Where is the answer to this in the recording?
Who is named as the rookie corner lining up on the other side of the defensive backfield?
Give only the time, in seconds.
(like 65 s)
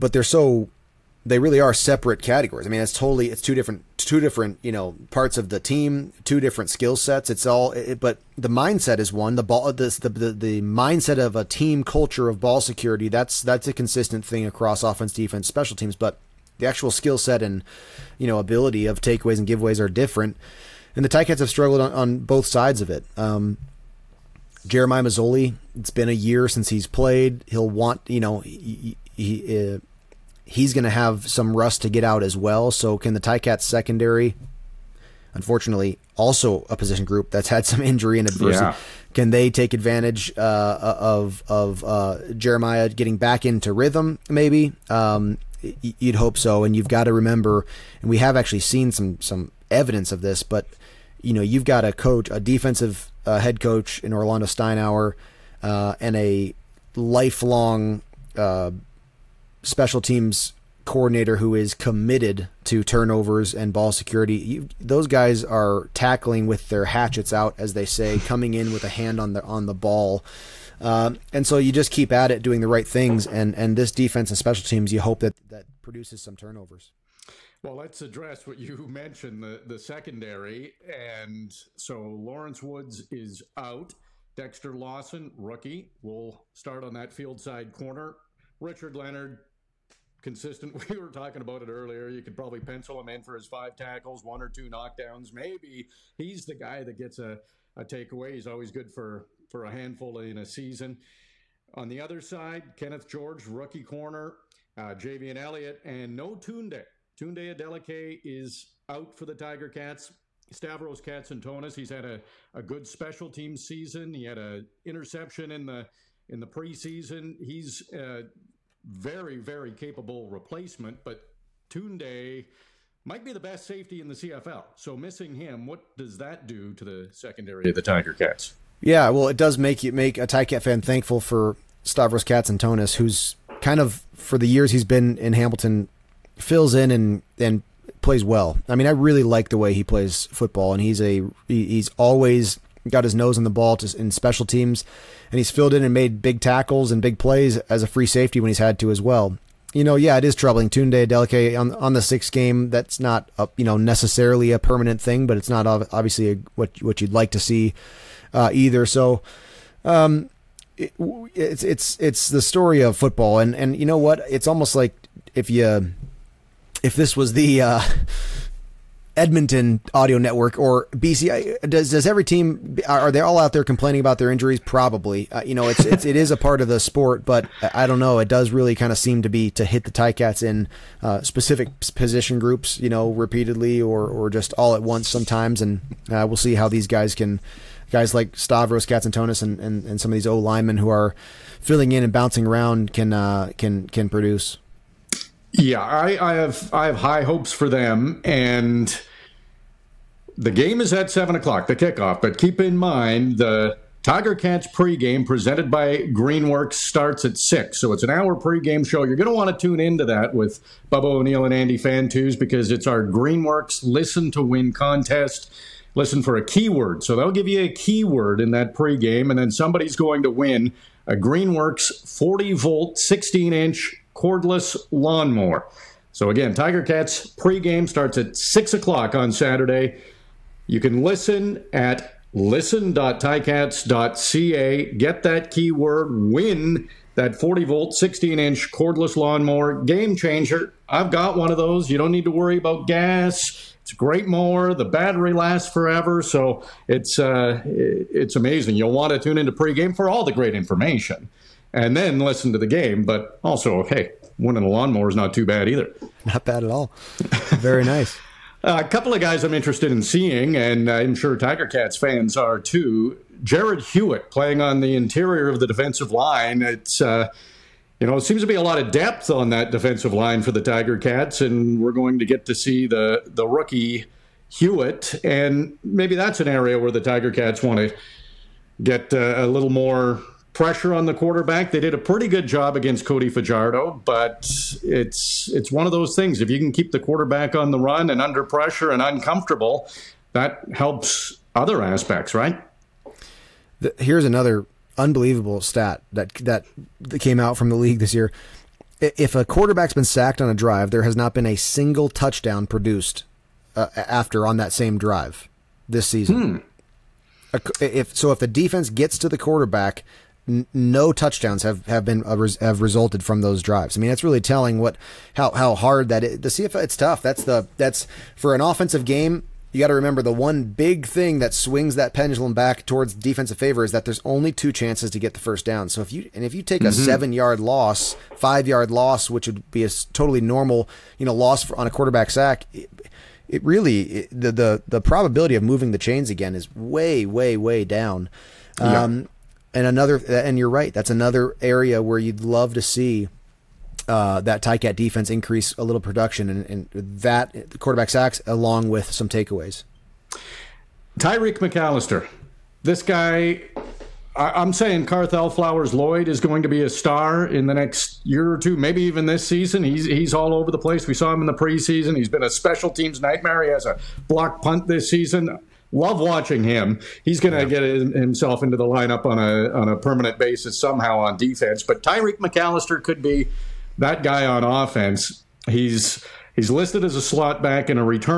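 102 s.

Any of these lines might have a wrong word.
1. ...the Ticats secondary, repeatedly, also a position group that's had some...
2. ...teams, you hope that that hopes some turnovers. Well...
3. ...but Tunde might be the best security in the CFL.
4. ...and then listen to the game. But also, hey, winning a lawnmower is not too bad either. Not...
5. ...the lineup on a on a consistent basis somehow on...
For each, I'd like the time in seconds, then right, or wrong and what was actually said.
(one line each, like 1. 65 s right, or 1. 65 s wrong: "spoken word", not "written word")
1. 33 s wrong: "unfortunately", not "repeatedly"
2. 74 s wrong: "produces", not "hopes"
3. 121 s wrong: "safety", not "security"
4. 251 s right
5. 368 s wrong: "permanent", not "consistent".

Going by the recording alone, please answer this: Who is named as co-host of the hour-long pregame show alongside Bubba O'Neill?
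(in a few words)
Andy Fantuz.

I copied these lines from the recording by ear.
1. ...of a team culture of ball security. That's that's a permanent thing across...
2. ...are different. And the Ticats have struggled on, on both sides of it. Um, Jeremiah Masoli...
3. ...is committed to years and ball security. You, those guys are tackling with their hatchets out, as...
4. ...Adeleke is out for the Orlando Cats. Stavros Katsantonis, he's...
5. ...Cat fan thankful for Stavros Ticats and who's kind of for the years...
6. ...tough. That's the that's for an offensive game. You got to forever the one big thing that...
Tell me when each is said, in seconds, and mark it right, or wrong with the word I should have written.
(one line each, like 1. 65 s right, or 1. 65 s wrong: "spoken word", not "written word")
1. 11 s wrong: "consistent", not "permanent"
2. 19 s right
3. 61 s wrong: "turnovers", not "years"
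4. 107 s wrong: "Tiger", not "Orlando"
5. 130 s wrong: "Katz", not "Ticats"
6. 316 s wrong: "remember", not "forever".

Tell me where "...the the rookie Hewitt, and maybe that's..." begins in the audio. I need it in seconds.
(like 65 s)
272 s.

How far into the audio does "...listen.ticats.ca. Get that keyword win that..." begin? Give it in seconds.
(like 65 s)
232 s.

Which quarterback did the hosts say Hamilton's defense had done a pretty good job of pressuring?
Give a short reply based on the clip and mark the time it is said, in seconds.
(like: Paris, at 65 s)
Cody Fajardo, at 283 s.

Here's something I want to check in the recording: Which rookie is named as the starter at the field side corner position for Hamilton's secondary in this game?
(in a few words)
Dexter Lawson.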